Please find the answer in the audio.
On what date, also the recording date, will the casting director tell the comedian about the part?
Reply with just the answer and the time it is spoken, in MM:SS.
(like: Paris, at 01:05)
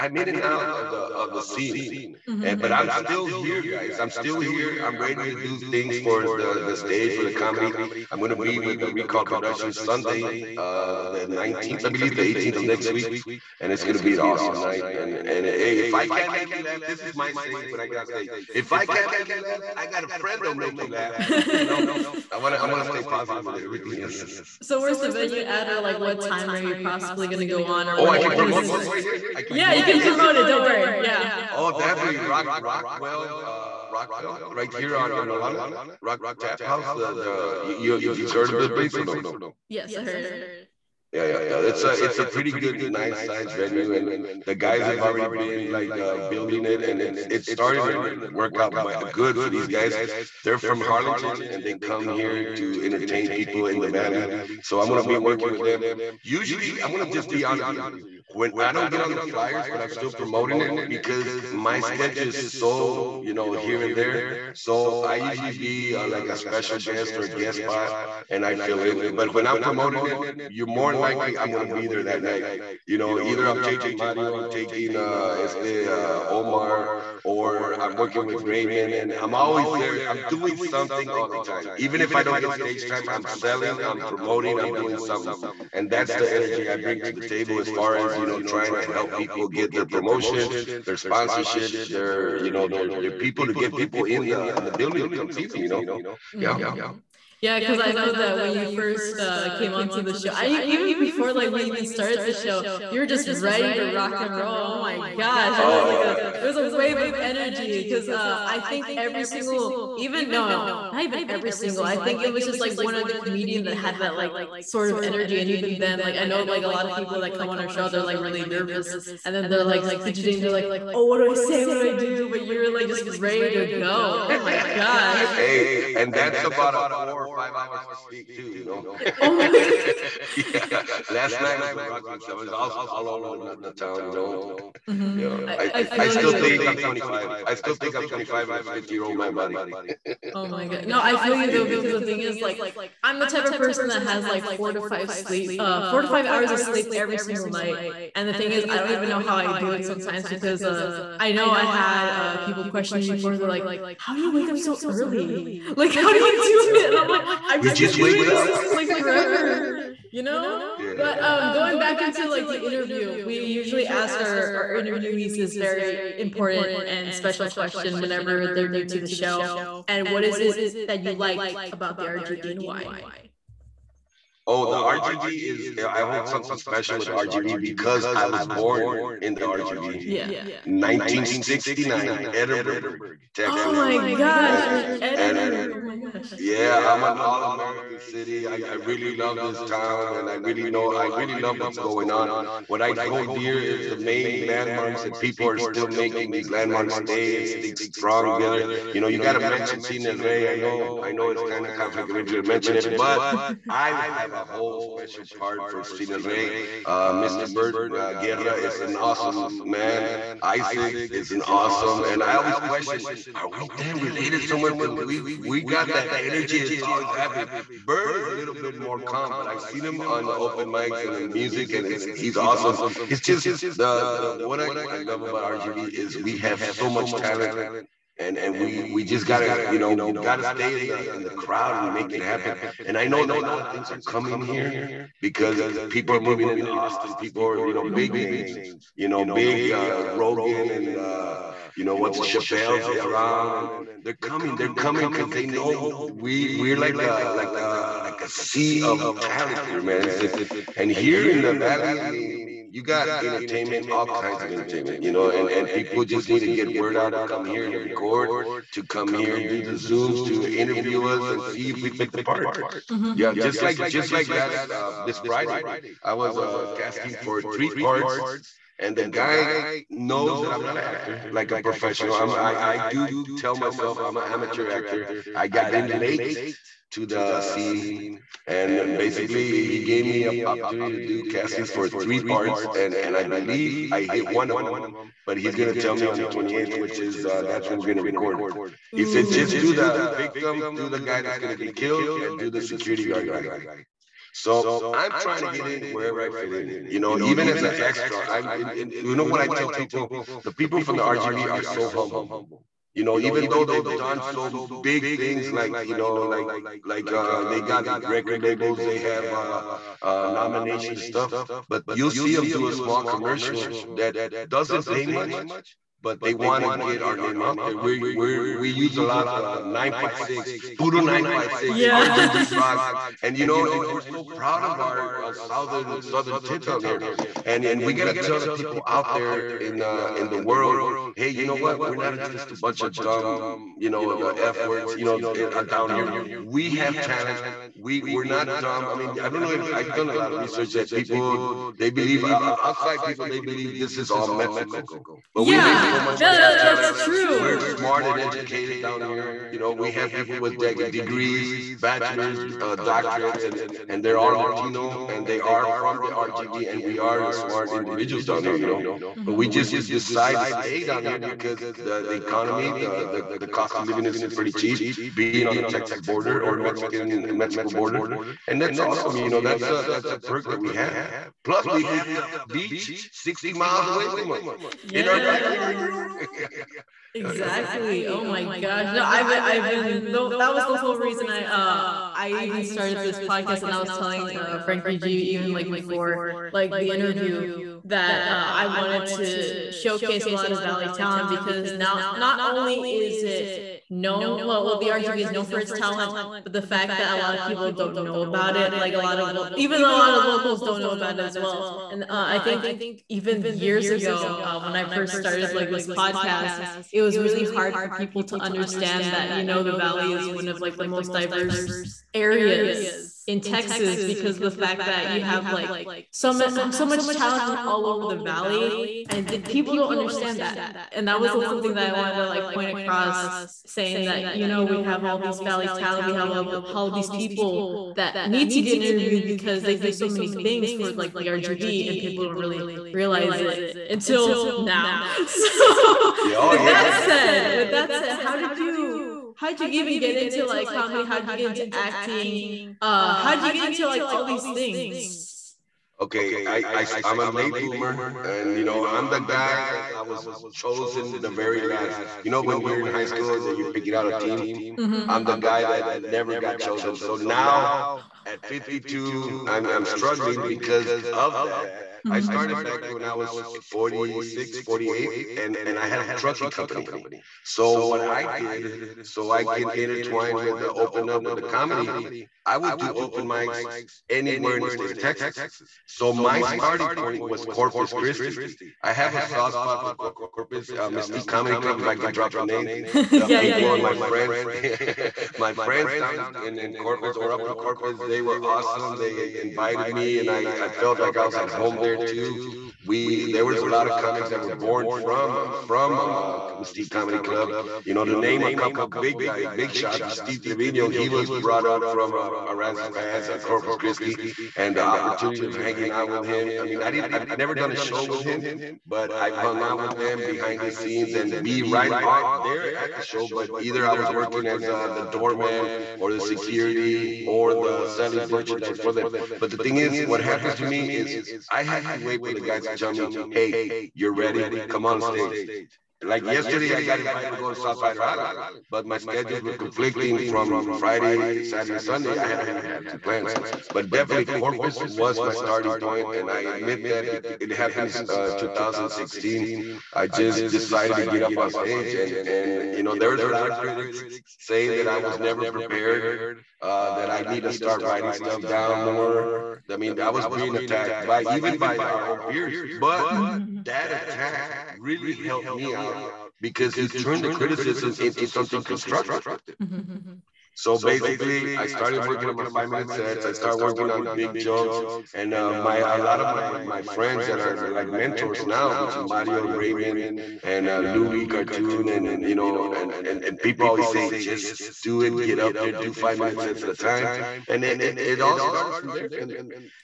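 the 28th, at 04:46.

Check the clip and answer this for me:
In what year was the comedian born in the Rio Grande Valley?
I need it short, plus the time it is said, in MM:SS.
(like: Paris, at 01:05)
1969, at 03:00.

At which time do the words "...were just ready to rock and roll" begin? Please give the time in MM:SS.
01:43.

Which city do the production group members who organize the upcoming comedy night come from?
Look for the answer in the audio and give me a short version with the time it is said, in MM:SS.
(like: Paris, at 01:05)
Harlingen, at 00:50.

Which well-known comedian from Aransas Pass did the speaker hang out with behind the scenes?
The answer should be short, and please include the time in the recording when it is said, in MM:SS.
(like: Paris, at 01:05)
Steve Trevino, at 08:20.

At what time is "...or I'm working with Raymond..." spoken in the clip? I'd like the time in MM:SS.
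01:17.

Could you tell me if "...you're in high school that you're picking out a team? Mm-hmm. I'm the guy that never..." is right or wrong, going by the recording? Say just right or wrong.
right.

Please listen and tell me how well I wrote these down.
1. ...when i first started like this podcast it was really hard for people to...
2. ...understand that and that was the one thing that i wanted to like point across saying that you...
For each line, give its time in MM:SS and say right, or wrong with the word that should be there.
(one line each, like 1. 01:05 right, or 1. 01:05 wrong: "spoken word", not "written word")
1. 06:44 right
2. 06:59 right.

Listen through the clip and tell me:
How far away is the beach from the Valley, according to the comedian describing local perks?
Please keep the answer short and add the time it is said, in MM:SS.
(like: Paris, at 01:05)
60 miles, at 06:13.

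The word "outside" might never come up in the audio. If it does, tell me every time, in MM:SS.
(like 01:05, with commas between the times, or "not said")
05:42.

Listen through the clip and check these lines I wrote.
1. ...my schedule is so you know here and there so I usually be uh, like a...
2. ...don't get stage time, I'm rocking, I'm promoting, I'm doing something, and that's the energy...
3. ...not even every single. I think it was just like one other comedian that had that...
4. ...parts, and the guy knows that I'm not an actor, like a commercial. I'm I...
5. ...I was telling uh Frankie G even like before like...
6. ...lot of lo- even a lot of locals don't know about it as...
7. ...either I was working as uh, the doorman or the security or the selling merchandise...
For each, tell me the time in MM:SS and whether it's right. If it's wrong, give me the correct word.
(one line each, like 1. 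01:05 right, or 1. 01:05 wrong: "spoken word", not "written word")
1. 01:01 right
2. 01:22 wrong: "selling", not "rocking"
3. 01:50 right
4. 04:27 wrong: "professional", not "commercial"
5. 06:23 right
6. 06:38 right
7. 08:33 right.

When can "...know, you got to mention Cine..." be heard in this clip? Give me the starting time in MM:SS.
03:19.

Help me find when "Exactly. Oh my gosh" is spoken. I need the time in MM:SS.
06:17.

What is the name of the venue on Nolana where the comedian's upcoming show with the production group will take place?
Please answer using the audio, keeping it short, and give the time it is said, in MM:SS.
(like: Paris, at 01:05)
Rock Tap House, at 00:36.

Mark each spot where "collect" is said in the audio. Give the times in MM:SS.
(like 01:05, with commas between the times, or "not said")
not said.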